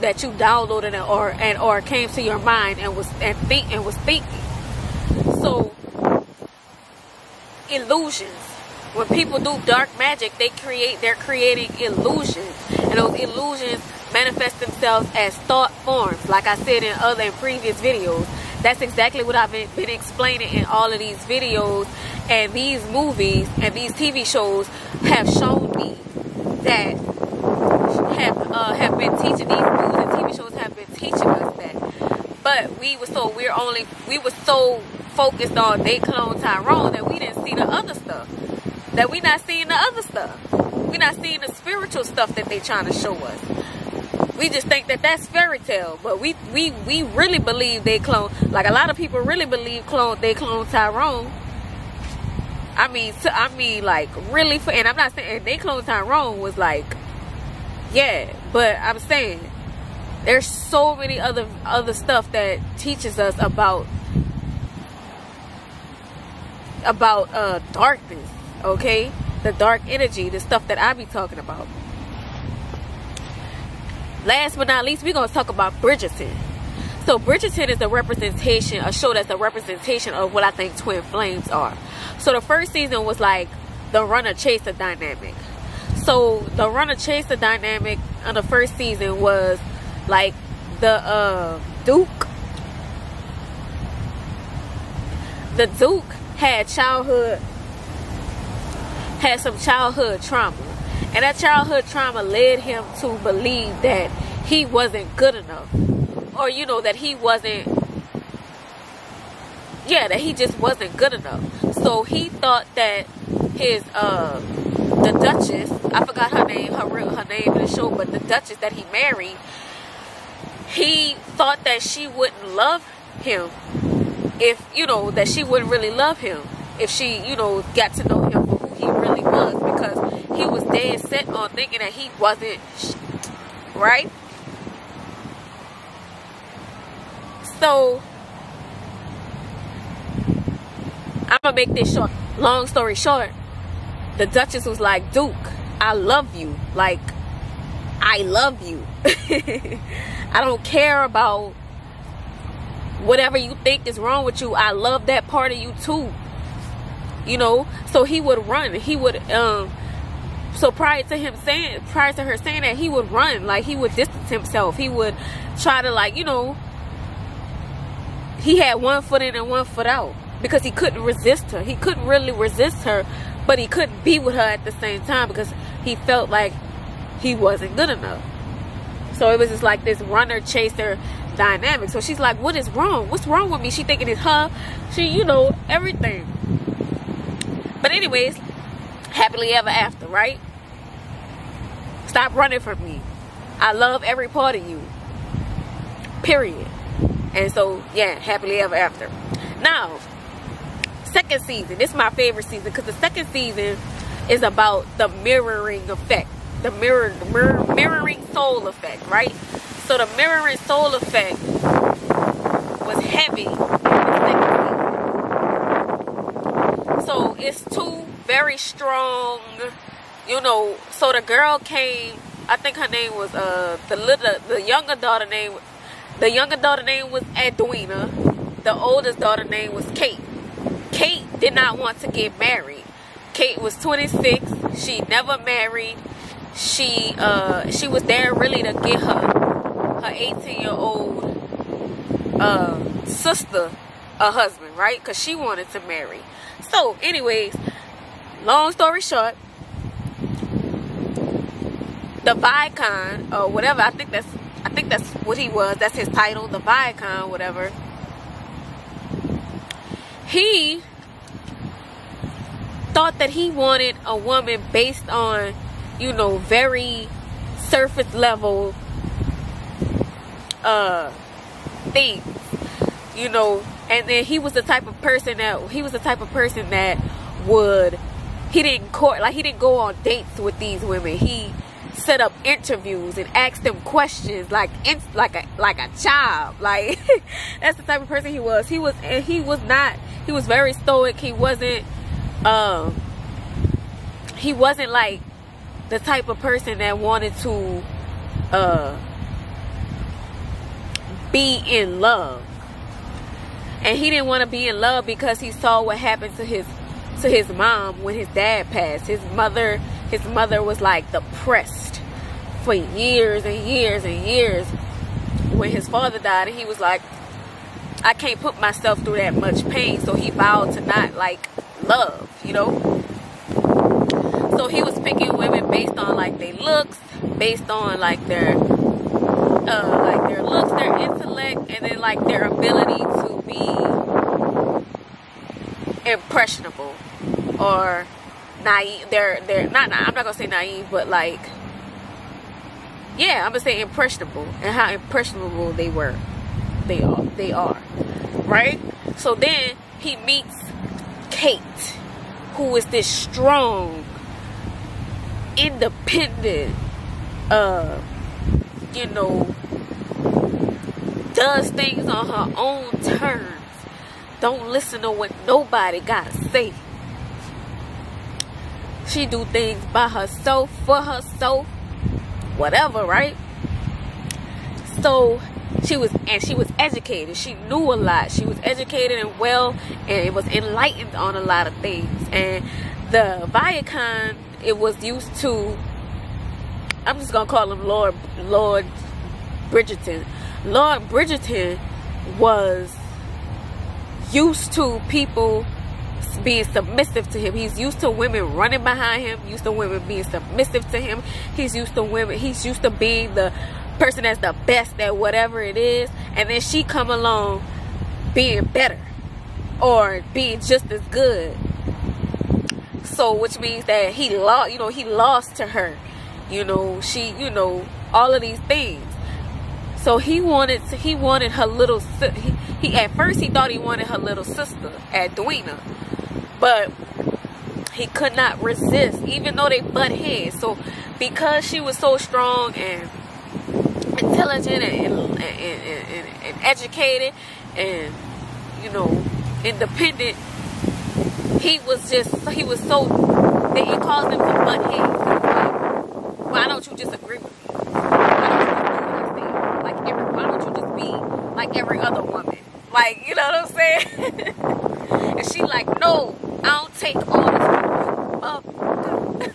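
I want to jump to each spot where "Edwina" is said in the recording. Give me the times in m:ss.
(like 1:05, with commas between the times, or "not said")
3:47, 7:05.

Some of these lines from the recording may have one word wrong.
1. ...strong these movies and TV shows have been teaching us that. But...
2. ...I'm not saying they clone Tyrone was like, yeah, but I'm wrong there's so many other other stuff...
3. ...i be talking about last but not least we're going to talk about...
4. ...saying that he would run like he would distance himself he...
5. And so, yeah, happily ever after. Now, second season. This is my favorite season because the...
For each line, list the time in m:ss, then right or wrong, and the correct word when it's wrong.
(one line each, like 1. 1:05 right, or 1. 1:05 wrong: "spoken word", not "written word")
1. 0:29 wrong: "teaching", not "strong"
2. 0:54 wrong: "saying", not "wrong"
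3. 1:10 right
4. 2:42 right
5. 3:17 right.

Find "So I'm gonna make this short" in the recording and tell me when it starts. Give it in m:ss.
2:17.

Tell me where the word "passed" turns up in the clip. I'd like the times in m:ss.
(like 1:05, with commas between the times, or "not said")
5:08.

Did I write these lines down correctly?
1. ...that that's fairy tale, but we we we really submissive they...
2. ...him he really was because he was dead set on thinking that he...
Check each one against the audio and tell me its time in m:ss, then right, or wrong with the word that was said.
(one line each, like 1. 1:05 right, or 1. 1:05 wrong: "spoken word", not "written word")
1. 0:44 wrong: "believe", not "submissive"
2. 2:08 right.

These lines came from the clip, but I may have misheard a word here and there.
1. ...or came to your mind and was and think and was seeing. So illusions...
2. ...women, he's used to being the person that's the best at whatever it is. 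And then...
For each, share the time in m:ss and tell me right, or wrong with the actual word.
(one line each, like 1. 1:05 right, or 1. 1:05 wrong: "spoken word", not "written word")
1. 0:01 wrong: "thinking", not "seeing"
2. 6:42 right.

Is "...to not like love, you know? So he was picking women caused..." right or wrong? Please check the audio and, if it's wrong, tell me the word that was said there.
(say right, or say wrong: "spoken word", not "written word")
wrong: "based", not "caused".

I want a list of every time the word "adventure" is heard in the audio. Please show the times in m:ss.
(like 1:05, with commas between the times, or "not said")
not said.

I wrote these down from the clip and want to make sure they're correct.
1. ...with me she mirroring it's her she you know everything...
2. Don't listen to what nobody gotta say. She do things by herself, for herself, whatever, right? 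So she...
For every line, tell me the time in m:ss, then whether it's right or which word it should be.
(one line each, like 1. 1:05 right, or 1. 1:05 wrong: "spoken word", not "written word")
1. 3:03 wrong: "thinking", not "mirroring"
2. 6:04 right.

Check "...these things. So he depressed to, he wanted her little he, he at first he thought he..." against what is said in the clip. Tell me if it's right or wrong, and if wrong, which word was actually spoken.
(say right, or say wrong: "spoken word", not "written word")
wrong: "wanted", not "depressed".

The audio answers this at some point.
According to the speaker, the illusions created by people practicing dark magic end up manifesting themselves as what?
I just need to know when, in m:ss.
0:15.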